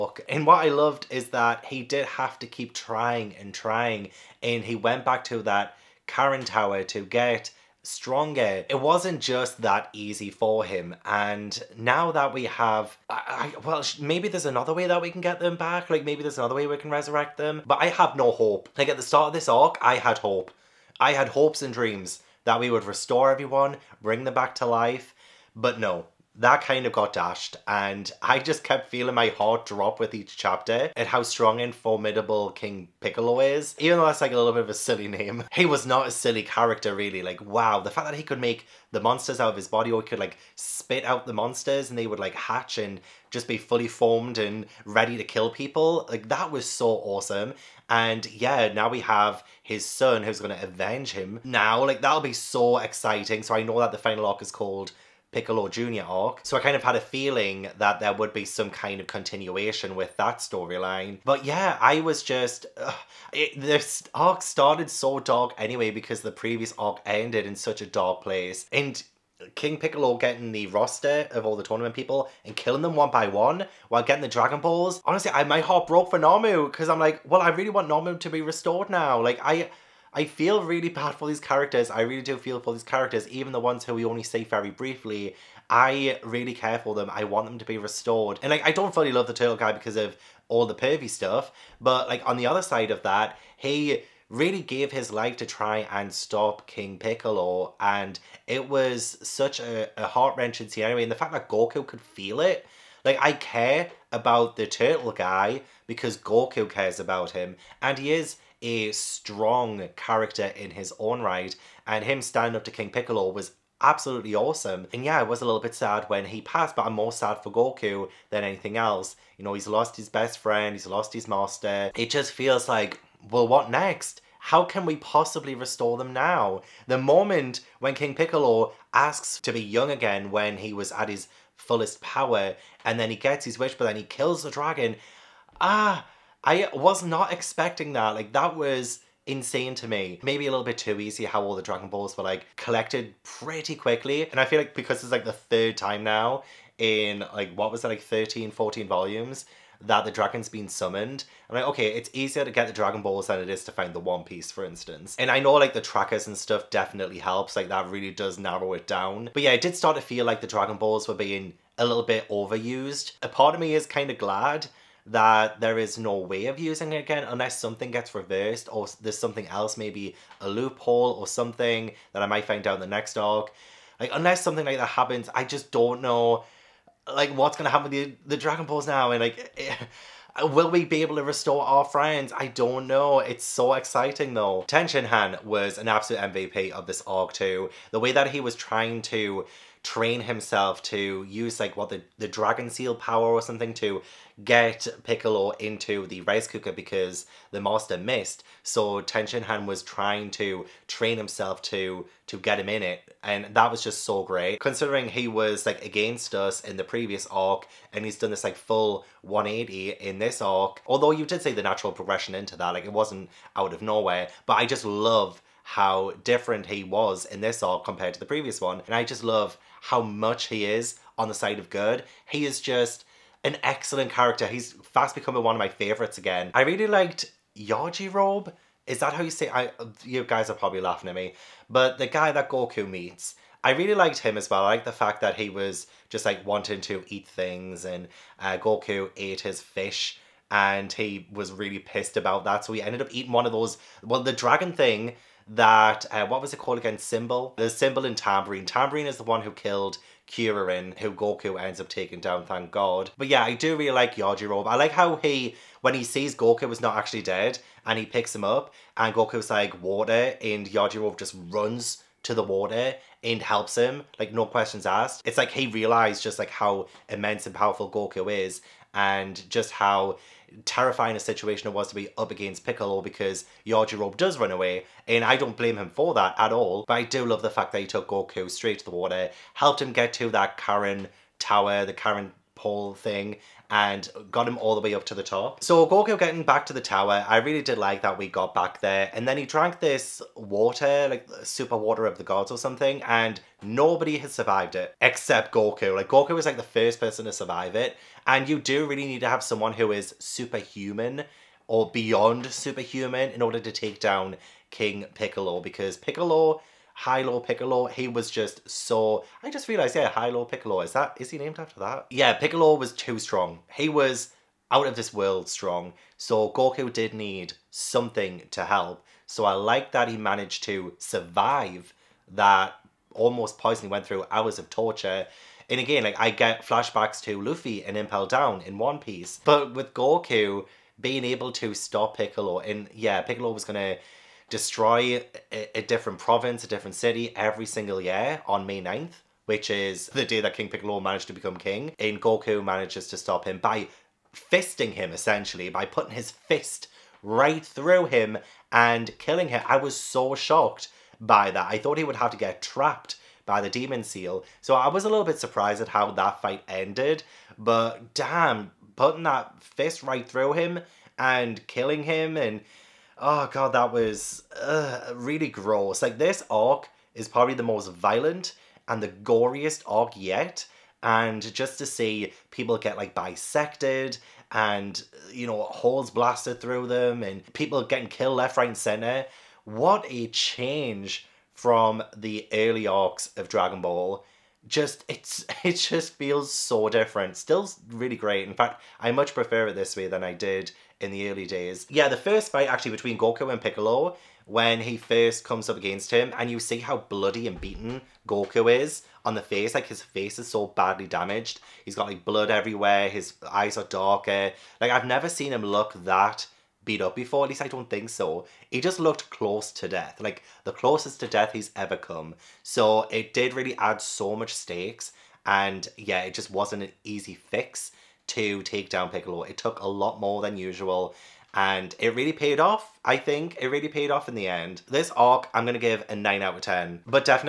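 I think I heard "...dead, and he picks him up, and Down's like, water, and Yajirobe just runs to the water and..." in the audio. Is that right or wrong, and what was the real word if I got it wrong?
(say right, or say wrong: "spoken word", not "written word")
wrong: "Goku", not "Down".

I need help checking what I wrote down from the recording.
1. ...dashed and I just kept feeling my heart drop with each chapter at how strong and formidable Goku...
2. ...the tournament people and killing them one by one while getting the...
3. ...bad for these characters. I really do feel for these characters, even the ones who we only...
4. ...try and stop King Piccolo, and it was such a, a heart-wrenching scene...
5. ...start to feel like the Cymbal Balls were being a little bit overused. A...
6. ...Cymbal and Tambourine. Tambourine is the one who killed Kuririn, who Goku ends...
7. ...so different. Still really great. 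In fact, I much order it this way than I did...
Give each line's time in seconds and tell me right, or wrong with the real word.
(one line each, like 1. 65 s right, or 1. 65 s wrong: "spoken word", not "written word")
1. 27 s wrong: "King", not "Goku"
2. 71 s right
3. 80 s right
4. 95 s right
5. 159 s wrong: "Dragon", not "Cymbal"
6. 247 s right
7. 386 s wrong: "prefer", not "order".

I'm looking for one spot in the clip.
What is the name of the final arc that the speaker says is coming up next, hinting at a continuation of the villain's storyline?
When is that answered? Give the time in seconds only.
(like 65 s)
55 s.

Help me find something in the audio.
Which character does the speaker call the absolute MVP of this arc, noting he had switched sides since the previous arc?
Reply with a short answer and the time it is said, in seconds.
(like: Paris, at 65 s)
Tenshinhan, at 184 s.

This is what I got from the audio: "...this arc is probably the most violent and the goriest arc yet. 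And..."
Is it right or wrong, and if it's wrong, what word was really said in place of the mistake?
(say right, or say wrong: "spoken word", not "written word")
right.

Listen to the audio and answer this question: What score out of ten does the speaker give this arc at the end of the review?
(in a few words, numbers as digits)
9.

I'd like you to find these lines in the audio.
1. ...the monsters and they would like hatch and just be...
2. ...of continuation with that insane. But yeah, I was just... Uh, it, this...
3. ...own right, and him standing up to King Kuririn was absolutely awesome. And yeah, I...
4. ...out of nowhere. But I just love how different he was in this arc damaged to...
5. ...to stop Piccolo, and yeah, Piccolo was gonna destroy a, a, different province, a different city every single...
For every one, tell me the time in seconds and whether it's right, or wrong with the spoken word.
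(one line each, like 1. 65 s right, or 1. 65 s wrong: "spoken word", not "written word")
1. 41 s right
2. 58 s wrong: "storyline", not "insane"
3. 110 s wrong: "Piccolo", not "Kuririn"
4. 213 s wrong: "compared", not "damaged"
5. 331 s right.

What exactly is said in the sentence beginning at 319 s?
So I like that he managed to survive that almost poison.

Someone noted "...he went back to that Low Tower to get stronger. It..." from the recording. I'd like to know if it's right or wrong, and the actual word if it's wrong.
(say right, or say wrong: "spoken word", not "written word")
wrong: "Karin", not "Low".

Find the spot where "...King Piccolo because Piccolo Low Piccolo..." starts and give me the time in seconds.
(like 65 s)
304 s.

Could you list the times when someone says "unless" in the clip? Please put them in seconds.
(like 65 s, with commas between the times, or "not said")
167 s, 174 s.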